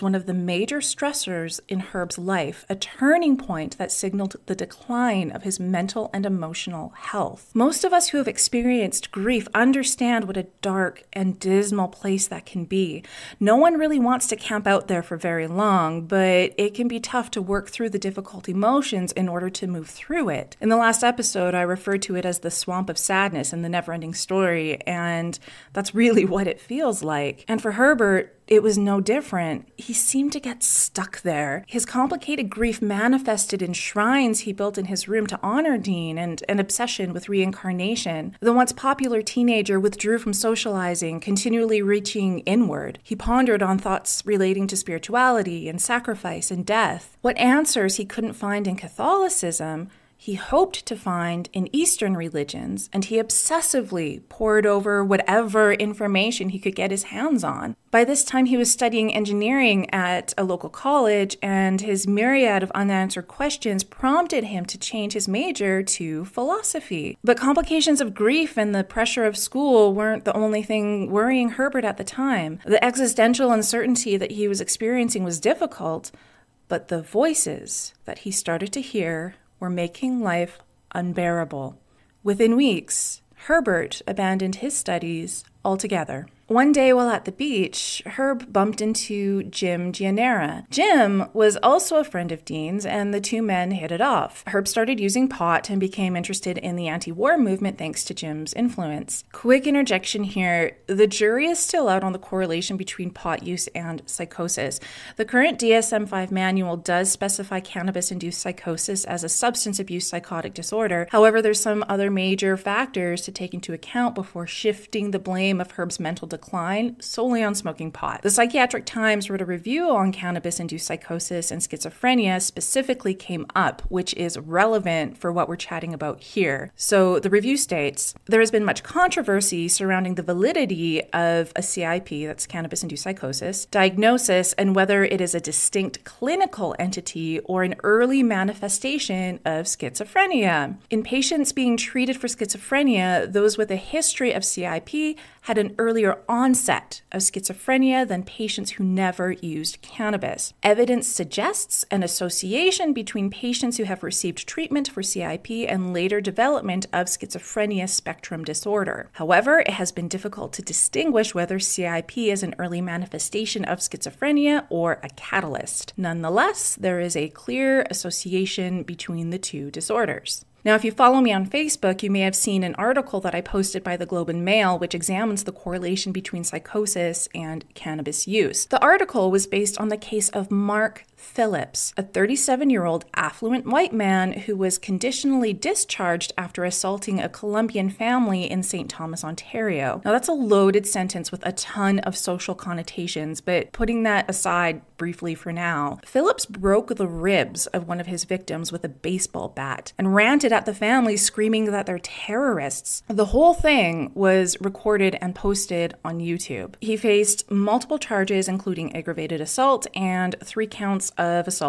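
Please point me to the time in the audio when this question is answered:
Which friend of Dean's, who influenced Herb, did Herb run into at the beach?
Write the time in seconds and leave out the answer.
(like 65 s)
89 s.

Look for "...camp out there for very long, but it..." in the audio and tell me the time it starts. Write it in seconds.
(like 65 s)
14 s.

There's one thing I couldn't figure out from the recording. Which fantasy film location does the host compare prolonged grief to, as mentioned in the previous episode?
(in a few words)
Swamp of sadness.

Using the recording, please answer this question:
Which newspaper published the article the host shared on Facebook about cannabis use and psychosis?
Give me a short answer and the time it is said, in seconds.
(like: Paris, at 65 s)
Globe and Mail, at 174 s.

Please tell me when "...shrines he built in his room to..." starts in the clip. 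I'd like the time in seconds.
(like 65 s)
33 s.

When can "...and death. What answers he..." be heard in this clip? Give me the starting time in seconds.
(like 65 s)
46 s.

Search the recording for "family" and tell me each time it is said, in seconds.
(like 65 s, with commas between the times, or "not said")
187 s, 200 s.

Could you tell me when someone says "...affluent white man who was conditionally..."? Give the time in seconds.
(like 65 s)
183 s.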